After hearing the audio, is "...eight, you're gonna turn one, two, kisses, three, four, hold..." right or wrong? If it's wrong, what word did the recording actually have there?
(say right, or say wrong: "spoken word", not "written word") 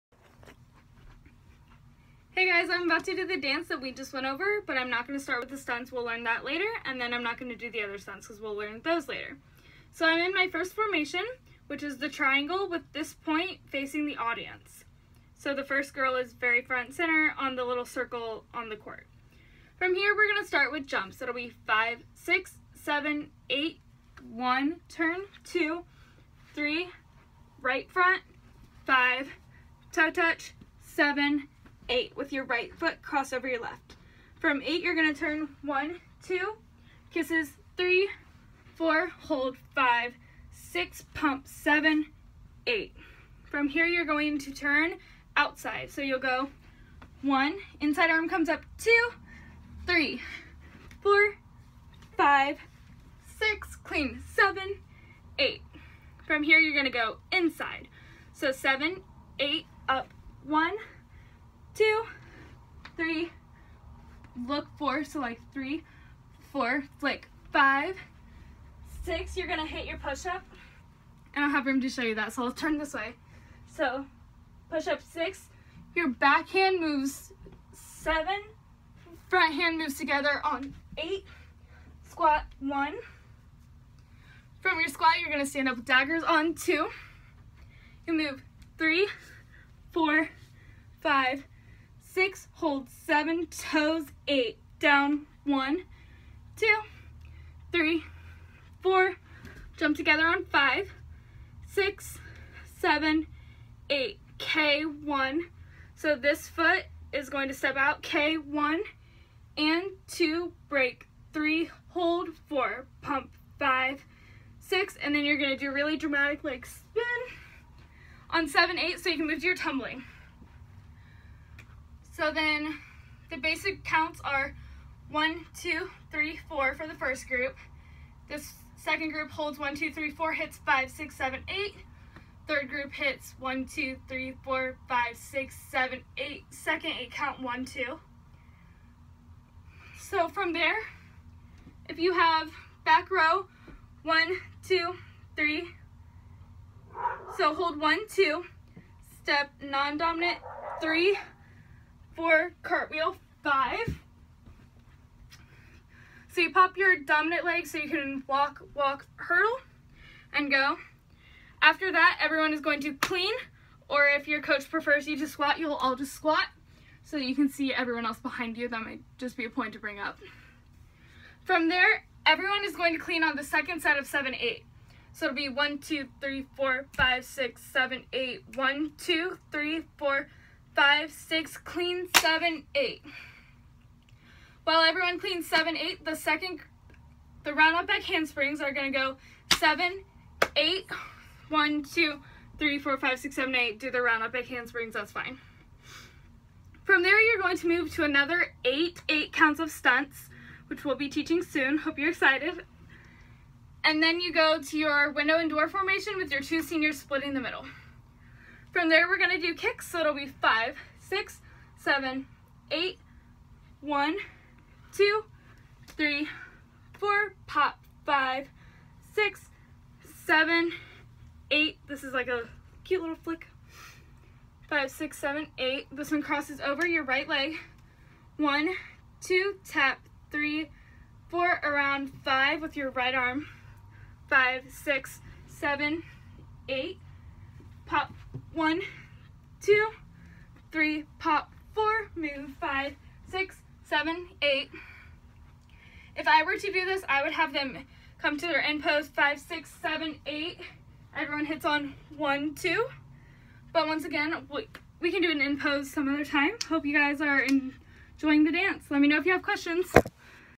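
right.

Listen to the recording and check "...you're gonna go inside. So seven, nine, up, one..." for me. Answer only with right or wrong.
wrong.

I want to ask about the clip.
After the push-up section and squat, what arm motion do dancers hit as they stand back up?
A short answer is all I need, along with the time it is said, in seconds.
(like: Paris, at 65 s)
Daggers, at 85 s.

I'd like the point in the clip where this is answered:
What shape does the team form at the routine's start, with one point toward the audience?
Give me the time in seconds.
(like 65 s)
11 s.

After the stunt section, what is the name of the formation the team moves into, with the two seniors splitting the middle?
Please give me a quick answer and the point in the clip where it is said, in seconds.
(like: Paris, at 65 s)
Window and door, at 205 s.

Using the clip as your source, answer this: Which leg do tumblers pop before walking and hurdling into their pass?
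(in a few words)
Dominant leg.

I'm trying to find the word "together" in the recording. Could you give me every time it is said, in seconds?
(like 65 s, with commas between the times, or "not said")
79 s, 99 s.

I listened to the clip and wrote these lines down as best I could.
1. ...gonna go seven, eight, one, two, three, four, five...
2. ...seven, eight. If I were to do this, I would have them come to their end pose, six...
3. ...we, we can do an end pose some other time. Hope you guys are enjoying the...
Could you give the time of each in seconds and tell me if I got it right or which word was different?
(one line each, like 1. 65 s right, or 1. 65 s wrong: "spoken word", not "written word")
1. 188 s right
2. 244 s wrong: "five", not "six"
3. 254 s right.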